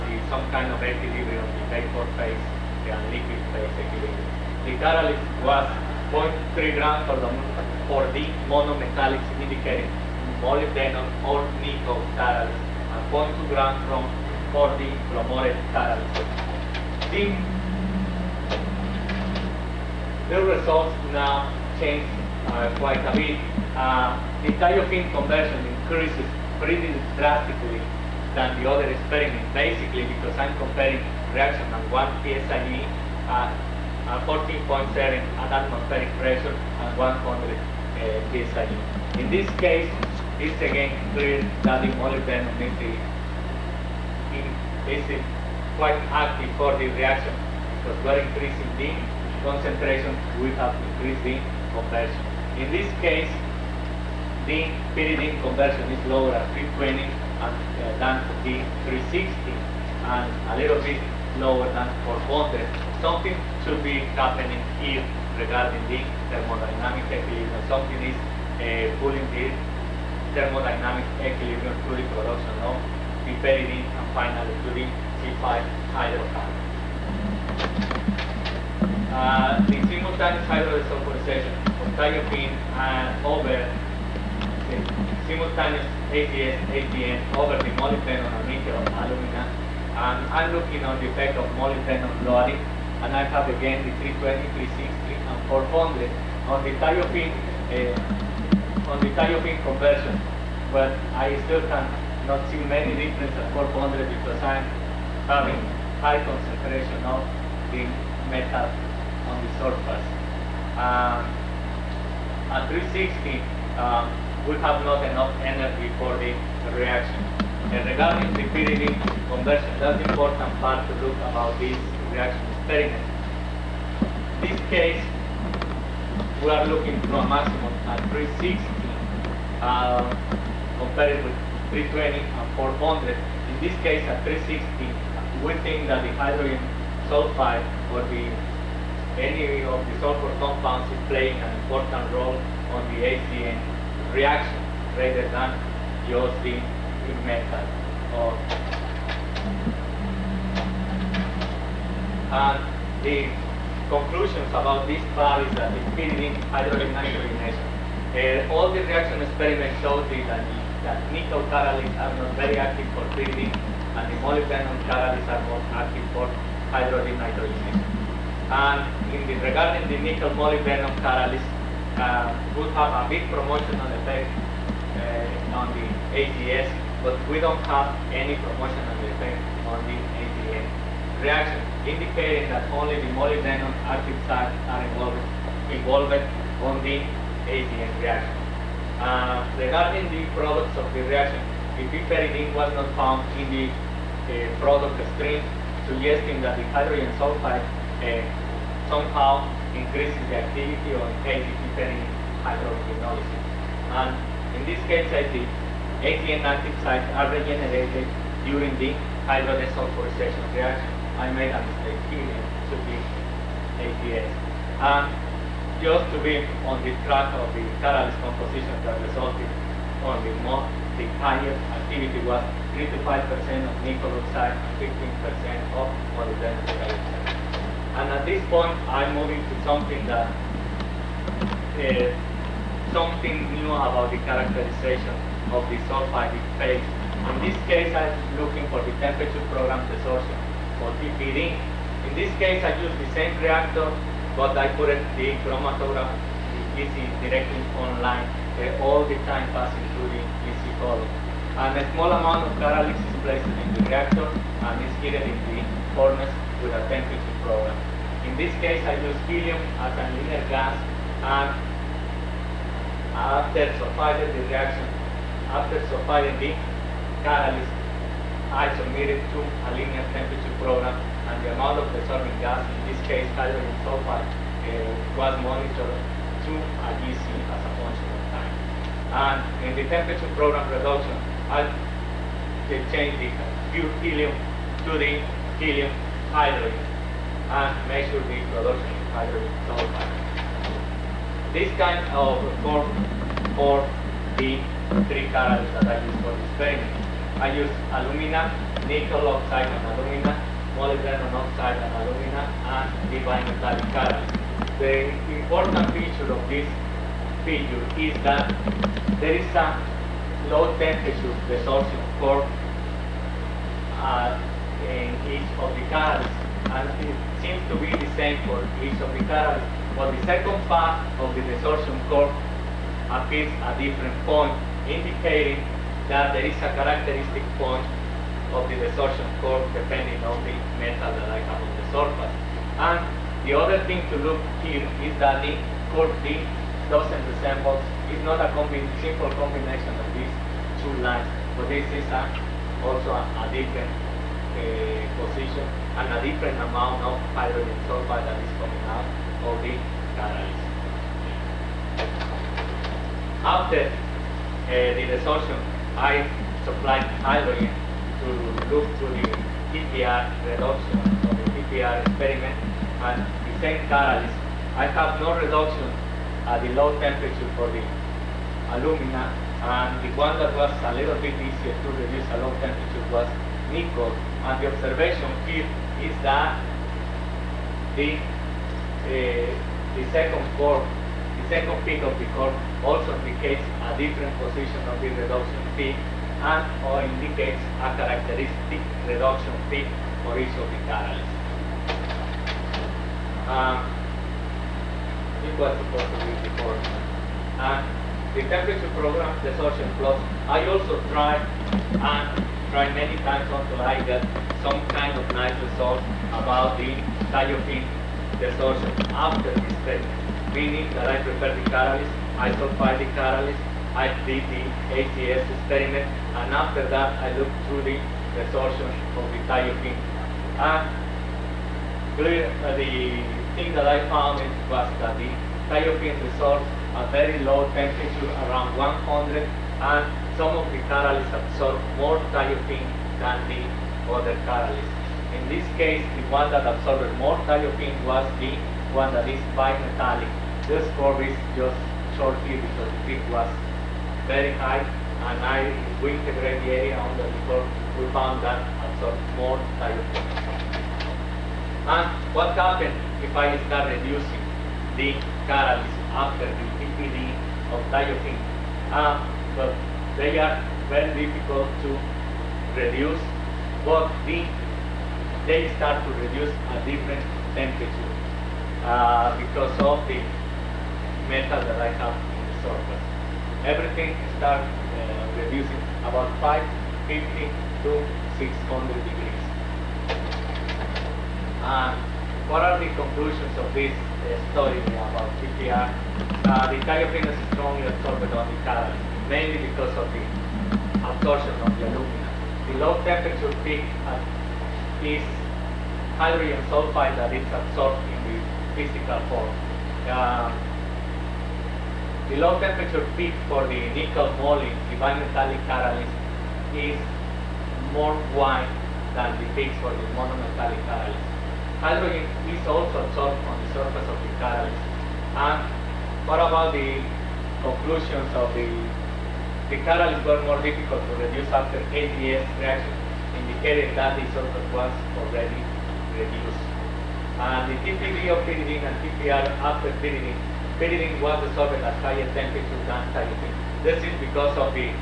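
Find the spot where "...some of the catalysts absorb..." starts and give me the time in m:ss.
7:10.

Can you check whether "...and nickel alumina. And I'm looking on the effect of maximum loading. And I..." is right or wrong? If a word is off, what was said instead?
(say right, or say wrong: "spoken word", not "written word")
wrong: "molybdenum", not "maximum".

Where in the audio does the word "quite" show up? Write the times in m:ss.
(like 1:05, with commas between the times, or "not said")
0:22, 0:45.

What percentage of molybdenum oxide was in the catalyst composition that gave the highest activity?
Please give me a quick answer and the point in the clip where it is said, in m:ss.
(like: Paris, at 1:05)
15%, at 3:44.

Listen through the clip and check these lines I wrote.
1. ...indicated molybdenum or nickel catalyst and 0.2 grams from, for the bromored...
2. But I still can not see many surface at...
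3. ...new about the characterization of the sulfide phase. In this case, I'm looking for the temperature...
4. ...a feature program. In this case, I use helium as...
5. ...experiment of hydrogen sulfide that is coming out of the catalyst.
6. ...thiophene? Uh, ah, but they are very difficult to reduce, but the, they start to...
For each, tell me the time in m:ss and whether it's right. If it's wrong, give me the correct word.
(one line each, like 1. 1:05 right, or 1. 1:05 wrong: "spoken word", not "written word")
1. 0:09 right
2. 1:40 wrong: "difference", not "surface"
3. 3:53 right
4. 4:16 wrong: "temperature", not "feature"
5. 5:46 wrong: "amount", not "experiment"
6. 7:37 right.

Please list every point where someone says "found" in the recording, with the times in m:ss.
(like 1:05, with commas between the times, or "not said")
3:12, 7:04, 7:28.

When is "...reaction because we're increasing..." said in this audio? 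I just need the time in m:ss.
0:46.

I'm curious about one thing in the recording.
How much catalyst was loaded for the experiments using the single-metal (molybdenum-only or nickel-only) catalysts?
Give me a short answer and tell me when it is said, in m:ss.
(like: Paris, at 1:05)
0.3 grams, at 0:06.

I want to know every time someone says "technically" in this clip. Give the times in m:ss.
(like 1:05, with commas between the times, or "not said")
not said.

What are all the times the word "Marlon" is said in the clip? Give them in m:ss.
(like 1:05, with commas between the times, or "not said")
not said.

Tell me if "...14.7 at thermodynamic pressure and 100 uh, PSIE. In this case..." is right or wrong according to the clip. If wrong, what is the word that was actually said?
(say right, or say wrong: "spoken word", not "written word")
wrong: "atmospheric", not "thermodynamic".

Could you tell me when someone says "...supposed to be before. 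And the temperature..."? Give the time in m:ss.
6:35.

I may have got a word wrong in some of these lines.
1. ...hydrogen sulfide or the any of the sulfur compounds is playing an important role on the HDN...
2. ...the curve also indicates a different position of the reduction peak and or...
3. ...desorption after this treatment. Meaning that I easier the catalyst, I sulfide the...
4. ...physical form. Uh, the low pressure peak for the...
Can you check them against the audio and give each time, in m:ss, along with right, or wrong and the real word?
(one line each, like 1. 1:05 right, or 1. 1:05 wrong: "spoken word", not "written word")
1. 2:16 right
2. 6:22 right
3. 6:48 wrong: "prefer", not "easier"
4. 8:18 wrong: "temperature", not "pressure".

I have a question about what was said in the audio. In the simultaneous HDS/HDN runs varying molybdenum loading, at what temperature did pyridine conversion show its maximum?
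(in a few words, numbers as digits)
360.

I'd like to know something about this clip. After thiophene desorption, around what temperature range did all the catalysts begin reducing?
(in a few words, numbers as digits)
550 to 600 degrees.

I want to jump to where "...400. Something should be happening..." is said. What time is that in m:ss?
1:02.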